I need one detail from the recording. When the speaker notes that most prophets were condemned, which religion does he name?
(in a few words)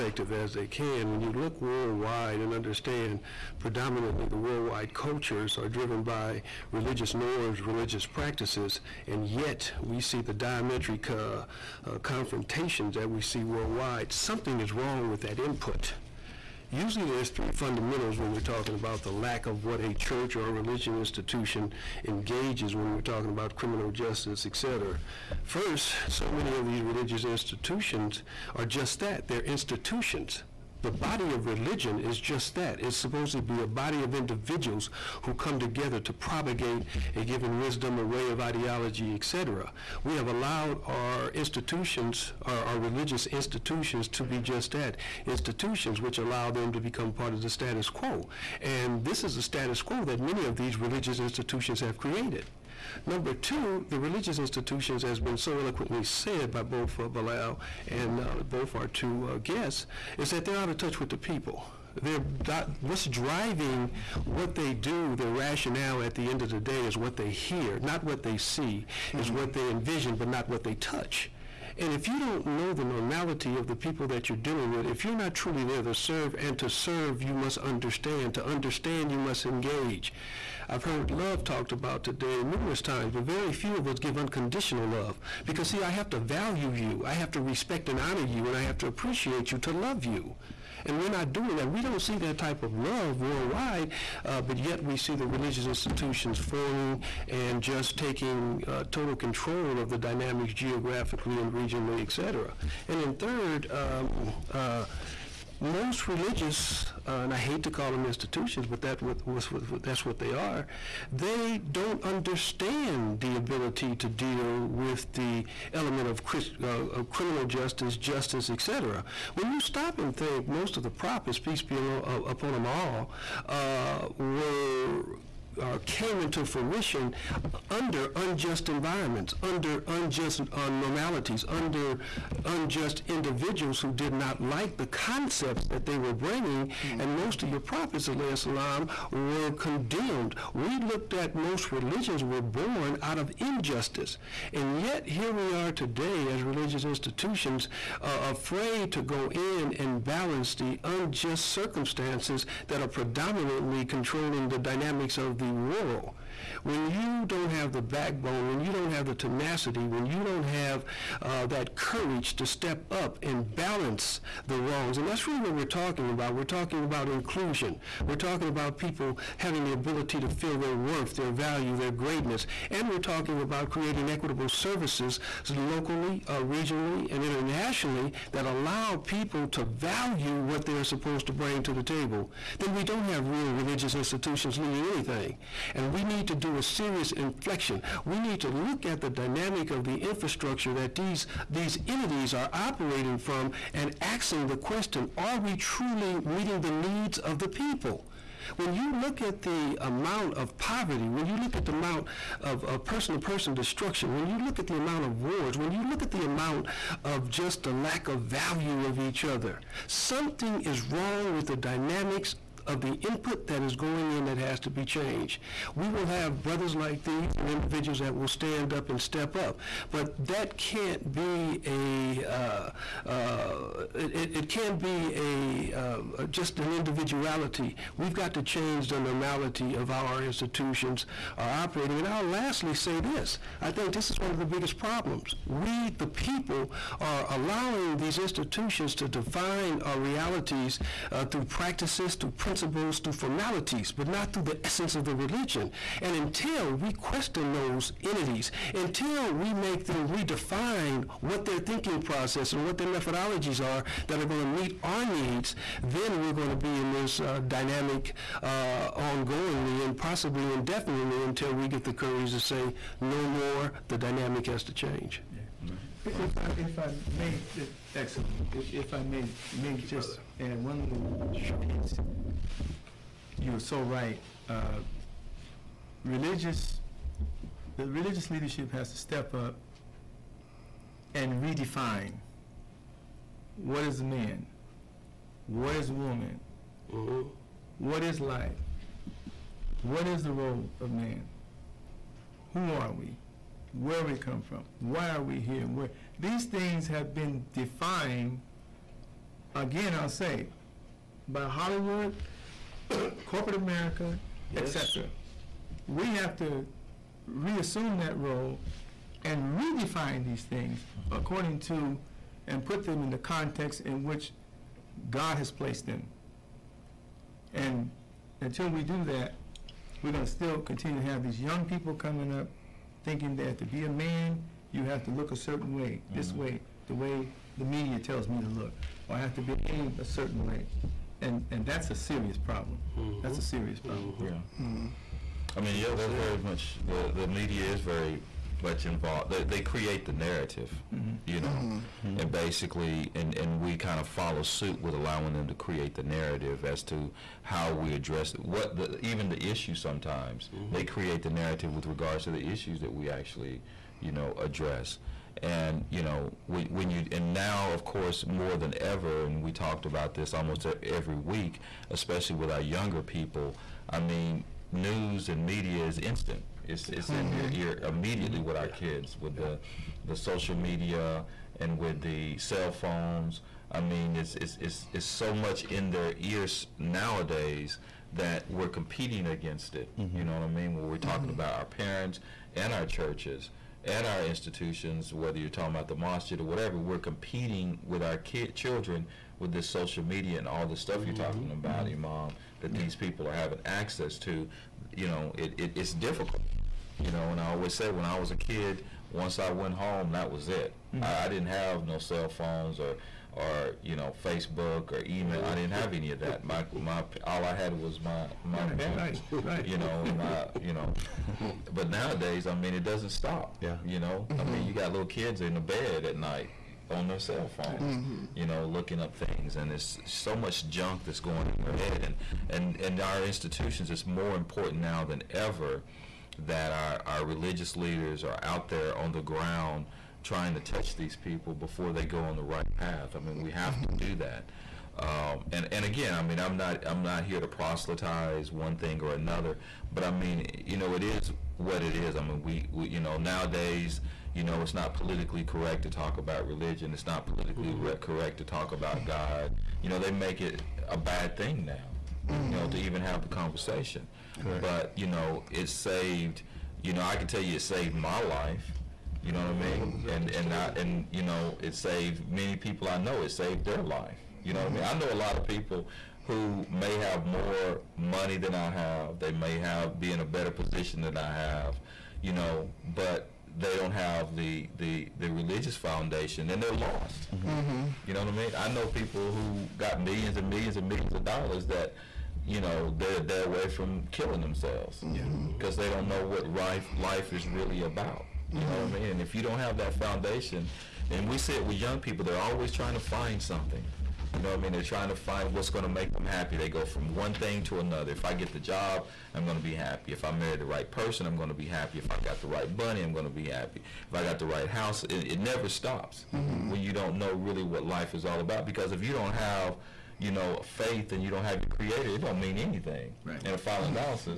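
Islam.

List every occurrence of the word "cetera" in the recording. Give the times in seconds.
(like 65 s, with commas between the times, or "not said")
24 s, 102 s.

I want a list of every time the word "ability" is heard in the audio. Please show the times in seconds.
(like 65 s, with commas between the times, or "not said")
113 s, 169 s.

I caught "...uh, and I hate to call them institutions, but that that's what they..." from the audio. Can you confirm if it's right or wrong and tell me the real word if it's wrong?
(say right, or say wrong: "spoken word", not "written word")
right.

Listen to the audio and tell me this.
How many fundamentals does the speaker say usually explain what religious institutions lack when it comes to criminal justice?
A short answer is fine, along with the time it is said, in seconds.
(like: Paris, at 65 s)
3, at 17 s.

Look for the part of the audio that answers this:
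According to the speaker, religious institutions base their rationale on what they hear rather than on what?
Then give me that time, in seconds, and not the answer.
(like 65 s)
67 s.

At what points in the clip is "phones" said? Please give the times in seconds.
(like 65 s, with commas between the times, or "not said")
372 s, 402 s, 417 s.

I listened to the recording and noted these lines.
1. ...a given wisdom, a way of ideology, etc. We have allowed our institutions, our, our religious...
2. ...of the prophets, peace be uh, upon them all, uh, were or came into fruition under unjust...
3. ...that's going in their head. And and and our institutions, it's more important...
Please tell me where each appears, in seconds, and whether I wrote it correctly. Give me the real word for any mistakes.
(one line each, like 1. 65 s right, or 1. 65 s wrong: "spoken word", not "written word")
1. 37 s right
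2. 120 s right
3. 421 s right.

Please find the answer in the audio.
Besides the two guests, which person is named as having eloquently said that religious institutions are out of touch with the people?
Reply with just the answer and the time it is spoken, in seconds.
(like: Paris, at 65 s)
Bilal, at 57 s.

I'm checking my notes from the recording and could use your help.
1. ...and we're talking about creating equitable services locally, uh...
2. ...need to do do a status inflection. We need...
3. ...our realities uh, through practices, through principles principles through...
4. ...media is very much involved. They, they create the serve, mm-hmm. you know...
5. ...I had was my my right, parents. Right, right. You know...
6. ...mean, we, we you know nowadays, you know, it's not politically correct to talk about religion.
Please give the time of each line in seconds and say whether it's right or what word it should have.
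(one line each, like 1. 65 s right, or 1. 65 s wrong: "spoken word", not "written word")
1. 172 s right
2. 186 s wrong: "serious", not "status"
3. 239 s right
4. 337 s wrong: "narrative", not "serve"
5. 407 s right
6. 442 s right.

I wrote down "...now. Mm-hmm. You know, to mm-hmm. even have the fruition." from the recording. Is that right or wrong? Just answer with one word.
wrong.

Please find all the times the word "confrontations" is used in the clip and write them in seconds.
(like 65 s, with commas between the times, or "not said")
11 s.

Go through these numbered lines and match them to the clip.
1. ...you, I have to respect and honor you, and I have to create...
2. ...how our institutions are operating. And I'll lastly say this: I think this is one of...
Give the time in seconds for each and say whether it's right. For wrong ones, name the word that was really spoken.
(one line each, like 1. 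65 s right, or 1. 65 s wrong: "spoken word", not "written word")
1. 86 s wrong: "appreciate", not "create"
2. 229 s right.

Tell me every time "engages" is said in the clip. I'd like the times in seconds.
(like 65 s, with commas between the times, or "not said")
22 s, 79 s.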